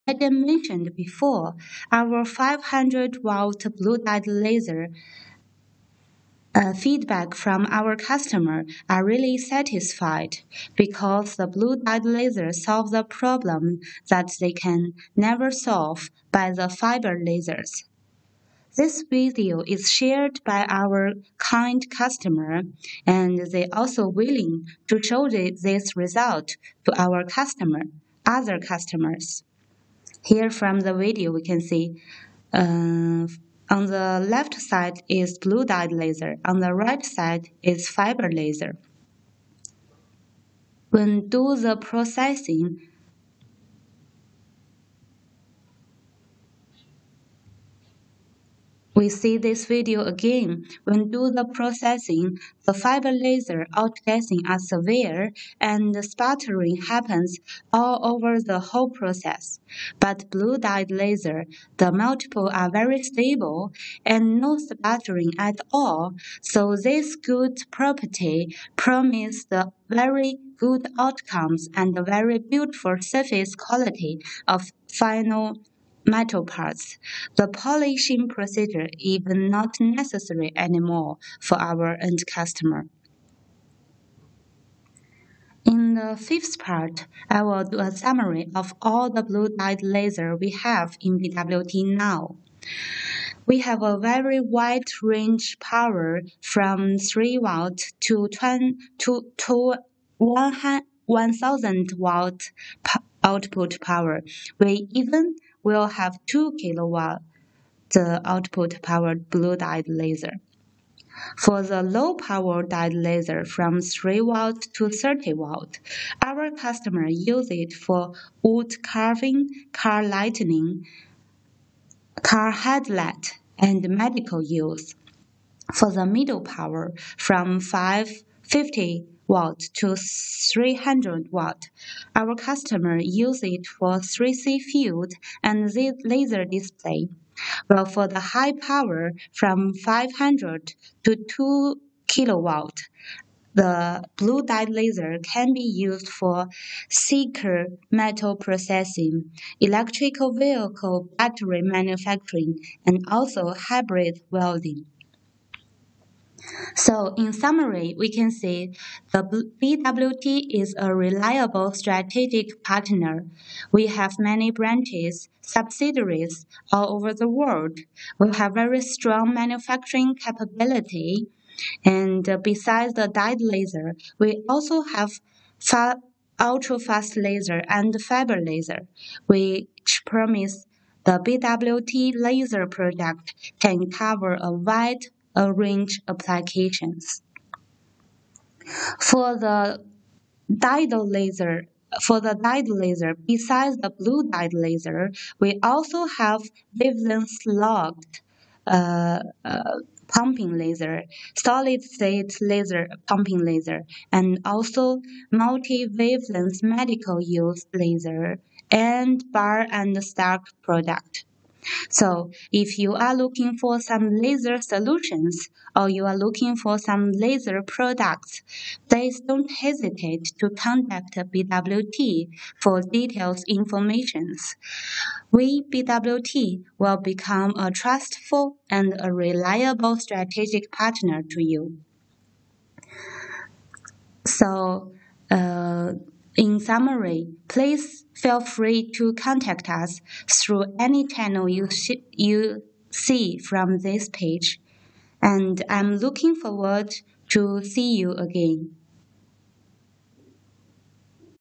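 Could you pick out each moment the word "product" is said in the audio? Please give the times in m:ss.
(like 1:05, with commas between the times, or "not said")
3:02, 3:30, 3:37.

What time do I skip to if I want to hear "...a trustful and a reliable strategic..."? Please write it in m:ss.
3:47.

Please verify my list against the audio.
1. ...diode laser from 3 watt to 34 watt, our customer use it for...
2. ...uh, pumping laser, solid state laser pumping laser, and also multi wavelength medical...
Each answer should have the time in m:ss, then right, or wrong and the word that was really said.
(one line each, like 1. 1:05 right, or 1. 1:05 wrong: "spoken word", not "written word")
1. 1:52 wrong: "30", not "34"
2. 3:19 right.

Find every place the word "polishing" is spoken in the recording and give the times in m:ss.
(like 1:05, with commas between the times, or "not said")
1:17.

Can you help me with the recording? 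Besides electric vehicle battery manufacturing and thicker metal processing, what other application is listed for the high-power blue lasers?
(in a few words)
Hybrid welding.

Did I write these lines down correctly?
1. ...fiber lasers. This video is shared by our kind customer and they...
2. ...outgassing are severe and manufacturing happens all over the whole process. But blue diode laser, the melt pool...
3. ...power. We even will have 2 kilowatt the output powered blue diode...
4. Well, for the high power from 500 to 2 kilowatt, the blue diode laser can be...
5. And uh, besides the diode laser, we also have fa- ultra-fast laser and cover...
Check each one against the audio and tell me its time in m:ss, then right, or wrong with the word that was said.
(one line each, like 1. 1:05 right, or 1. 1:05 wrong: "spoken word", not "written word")
1. 0:16 right
2. 0:53 wrong: "sputtering", not "manufacturing"
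3. 1:43 right
4. 2:17 right
5. 2:51 wrong: "fiber", not "cover".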